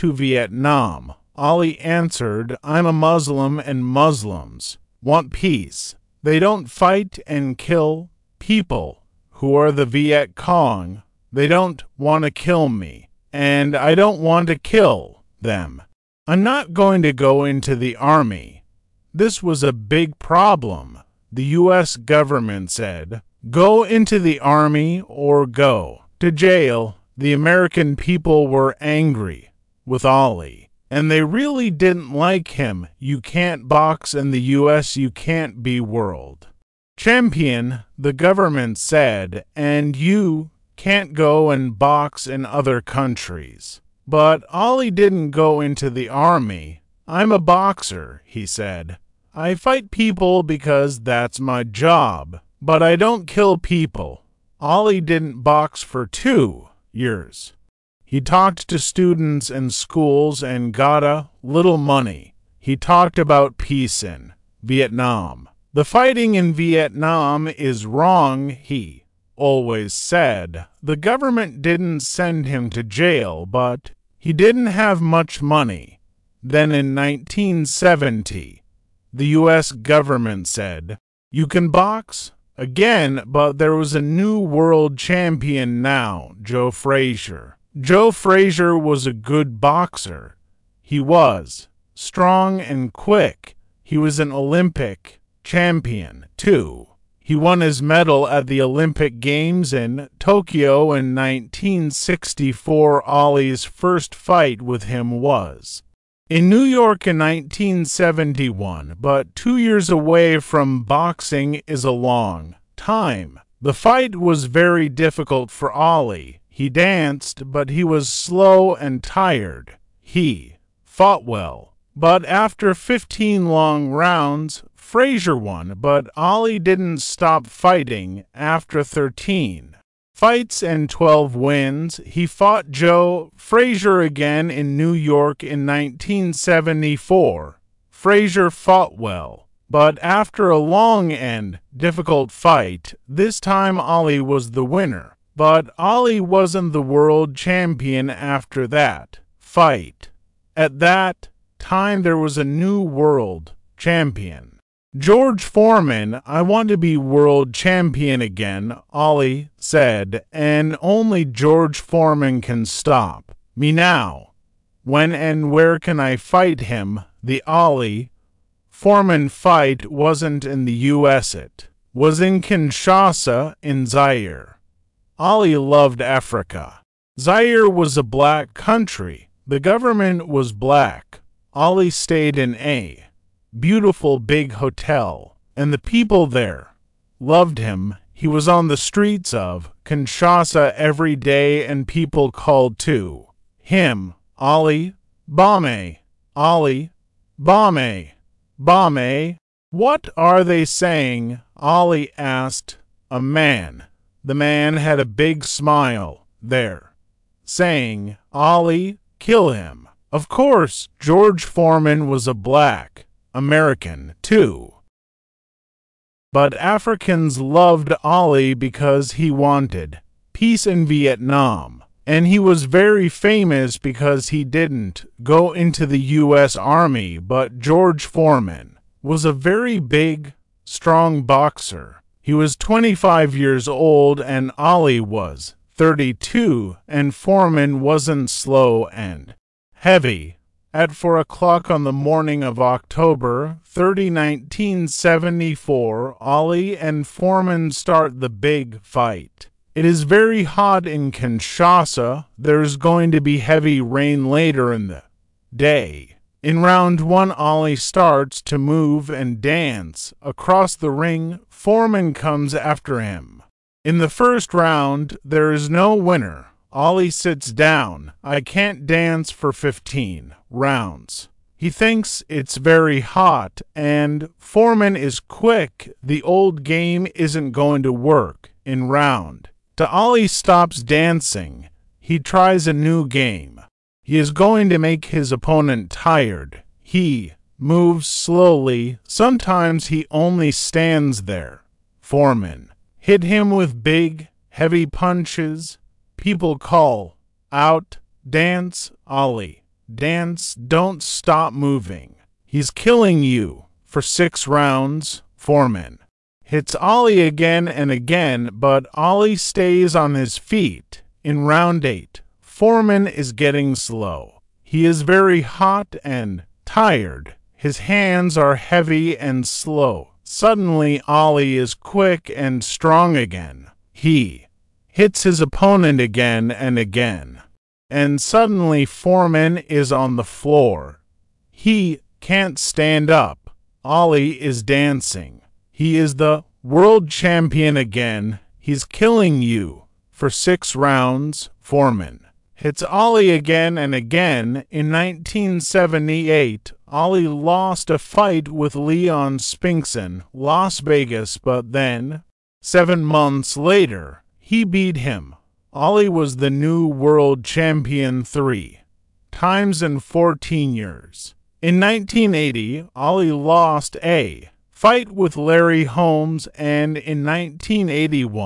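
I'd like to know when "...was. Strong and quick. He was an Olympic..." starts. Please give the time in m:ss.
1:30.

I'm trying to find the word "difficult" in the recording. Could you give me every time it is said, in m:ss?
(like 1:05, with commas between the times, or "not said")
1:54, 2:21.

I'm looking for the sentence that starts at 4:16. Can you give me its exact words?
In round one, Ali starts to move and dance.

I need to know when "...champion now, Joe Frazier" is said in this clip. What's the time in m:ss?
1:24.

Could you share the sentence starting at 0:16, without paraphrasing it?
I'm not going to go into the army.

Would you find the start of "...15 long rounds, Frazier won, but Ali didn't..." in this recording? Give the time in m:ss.
2:02.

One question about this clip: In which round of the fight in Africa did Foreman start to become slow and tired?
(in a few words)
8.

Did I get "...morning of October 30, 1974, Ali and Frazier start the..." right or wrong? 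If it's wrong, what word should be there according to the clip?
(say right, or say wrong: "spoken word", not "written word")
wrong: "Foreman", not "Frazier".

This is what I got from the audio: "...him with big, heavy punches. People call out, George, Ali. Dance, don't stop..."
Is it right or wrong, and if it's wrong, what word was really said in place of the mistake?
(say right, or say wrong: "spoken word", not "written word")
wrong: "Dance", not "George".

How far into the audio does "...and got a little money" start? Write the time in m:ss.
1:00.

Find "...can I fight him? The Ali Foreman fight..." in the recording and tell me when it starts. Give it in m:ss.
2:45.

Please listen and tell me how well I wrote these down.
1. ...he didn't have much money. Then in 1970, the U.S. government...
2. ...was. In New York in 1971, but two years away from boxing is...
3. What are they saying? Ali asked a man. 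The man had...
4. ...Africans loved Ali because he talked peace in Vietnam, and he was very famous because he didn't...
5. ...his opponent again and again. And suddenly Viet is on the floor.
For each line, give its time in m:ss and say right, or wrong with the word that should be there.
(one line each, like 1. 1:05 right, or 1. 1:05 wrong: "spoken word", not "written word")
1. 1:14 right
2. 1:45 right
3. 3:19 right
4. 3:36 wrong: "wanted", not "talked"
5. 5:25 wrong: "Foreman", not "Viet".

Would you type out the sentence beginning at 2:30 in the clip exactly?
At that time, there was a new world champion.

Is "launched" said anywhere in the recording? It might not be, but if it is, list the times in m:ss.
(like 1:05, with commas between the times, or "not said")
not said.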